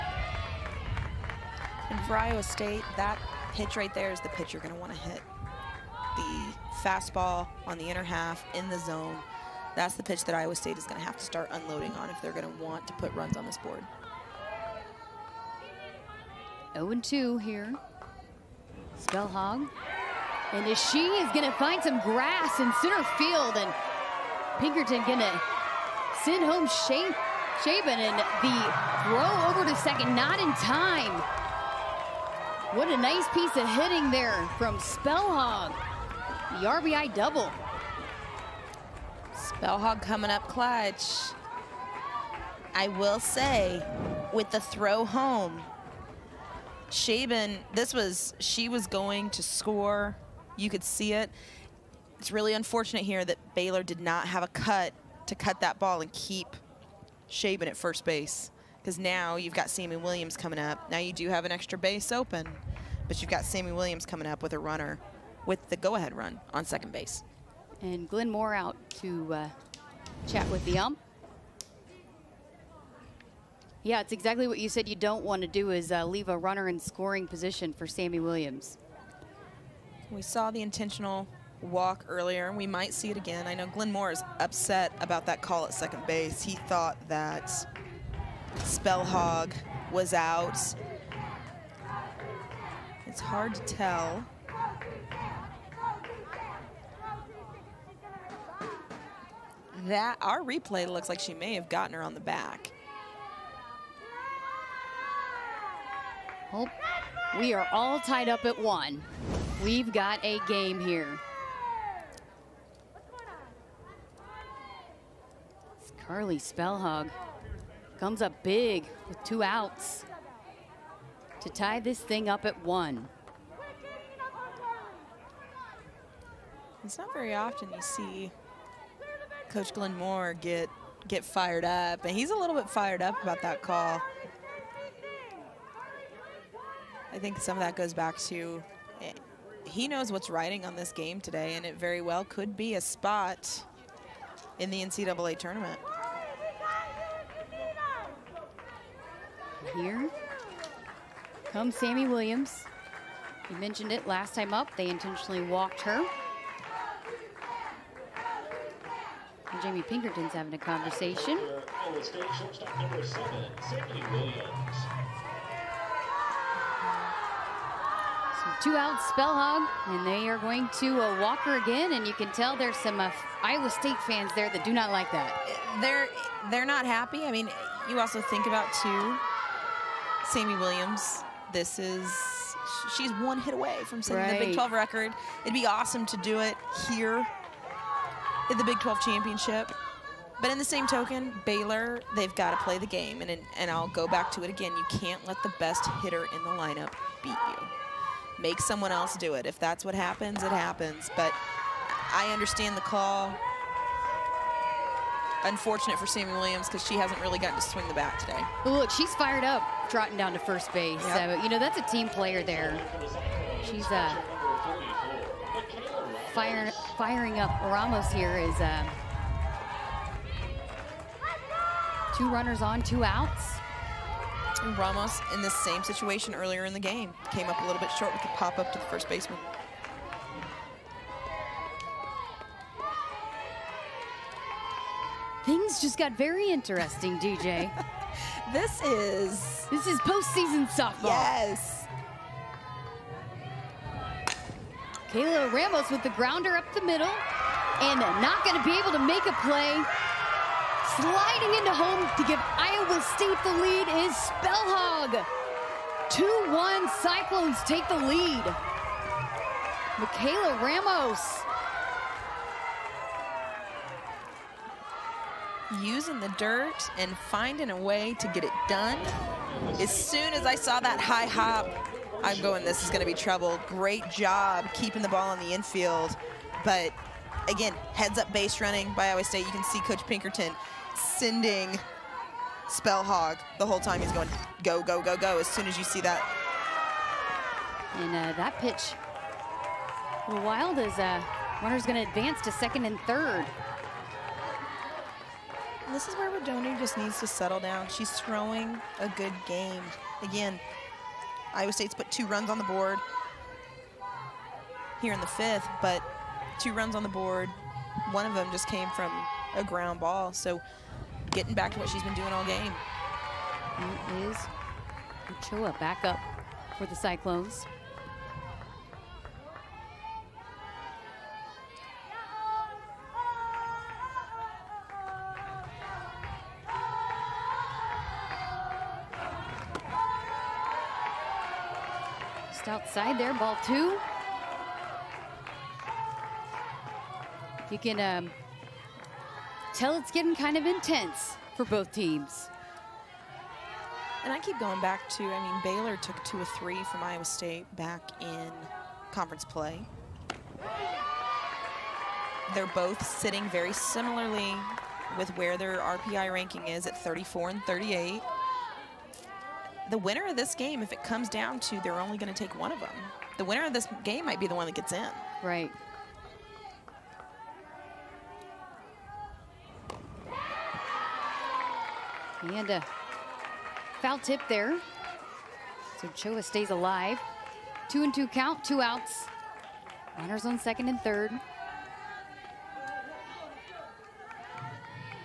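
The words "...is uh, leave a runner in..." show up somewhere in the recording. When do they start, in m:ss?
1:15.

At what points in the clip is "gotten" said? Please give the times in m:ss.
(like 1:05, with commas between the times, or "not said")
1:41, 3:27.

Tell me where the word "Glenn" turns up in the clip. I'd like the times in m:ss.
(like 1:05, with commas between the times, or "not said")
1:08, 1:23, 2:09.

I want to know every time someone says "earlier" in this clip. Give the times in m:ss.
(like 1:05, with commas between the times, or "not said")
1:22, 3:46.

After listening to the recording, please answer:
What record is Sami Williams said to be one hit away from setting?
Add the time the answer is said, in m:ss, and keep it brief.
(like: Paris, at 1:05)
Big 12 record, at 3:04.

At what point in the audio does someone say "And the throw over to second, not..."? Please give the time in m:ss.
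0:27.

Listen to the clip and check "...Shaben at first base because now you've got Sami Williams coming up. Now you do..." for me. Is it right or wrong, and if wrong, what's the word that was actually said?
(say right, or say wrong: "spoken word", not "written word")
right.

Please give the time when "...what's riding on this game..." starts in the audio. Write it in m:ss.
2:20.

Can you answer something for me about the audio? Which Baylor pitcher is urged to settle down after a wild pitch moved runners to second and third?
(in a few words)
Rodoni.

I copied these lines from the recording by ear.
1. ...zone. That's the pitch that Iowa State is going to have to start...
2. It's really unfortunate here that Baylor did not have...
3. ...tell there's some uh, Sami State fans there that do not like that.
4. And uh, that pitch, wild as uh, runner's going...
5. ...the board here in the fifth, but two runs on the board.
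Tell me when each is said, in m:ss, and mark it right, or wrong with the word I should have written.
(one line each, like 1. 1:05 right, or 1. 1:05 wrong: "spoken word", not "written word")
1. 0:08 right
2. 0:52 right
3. 2:52 wrong: "Iowa", not "Sami"
4. 4:47 right
5. 5:02 right.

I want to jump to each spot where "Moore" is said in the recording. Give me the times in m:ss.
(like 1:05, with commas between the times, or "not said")
1:08, 1:23, 2:09.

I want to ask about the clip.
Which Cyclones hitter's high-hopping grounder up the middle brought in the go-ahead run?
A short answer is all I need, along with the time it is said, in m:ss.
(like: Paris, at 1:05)
Kayla Ramos, at 4:05.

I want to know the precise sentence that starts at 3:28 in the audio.
Well, look, she's fired up trotting down to first base.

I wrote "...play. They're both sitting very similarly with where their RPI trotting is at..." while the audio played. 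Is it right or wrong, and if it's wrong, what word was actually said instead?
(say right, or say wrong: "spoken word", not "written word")
wrong: "ranking", not "trotting".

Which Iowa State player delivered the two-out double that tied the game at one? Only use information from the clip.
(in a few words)
Carly Spelhaug.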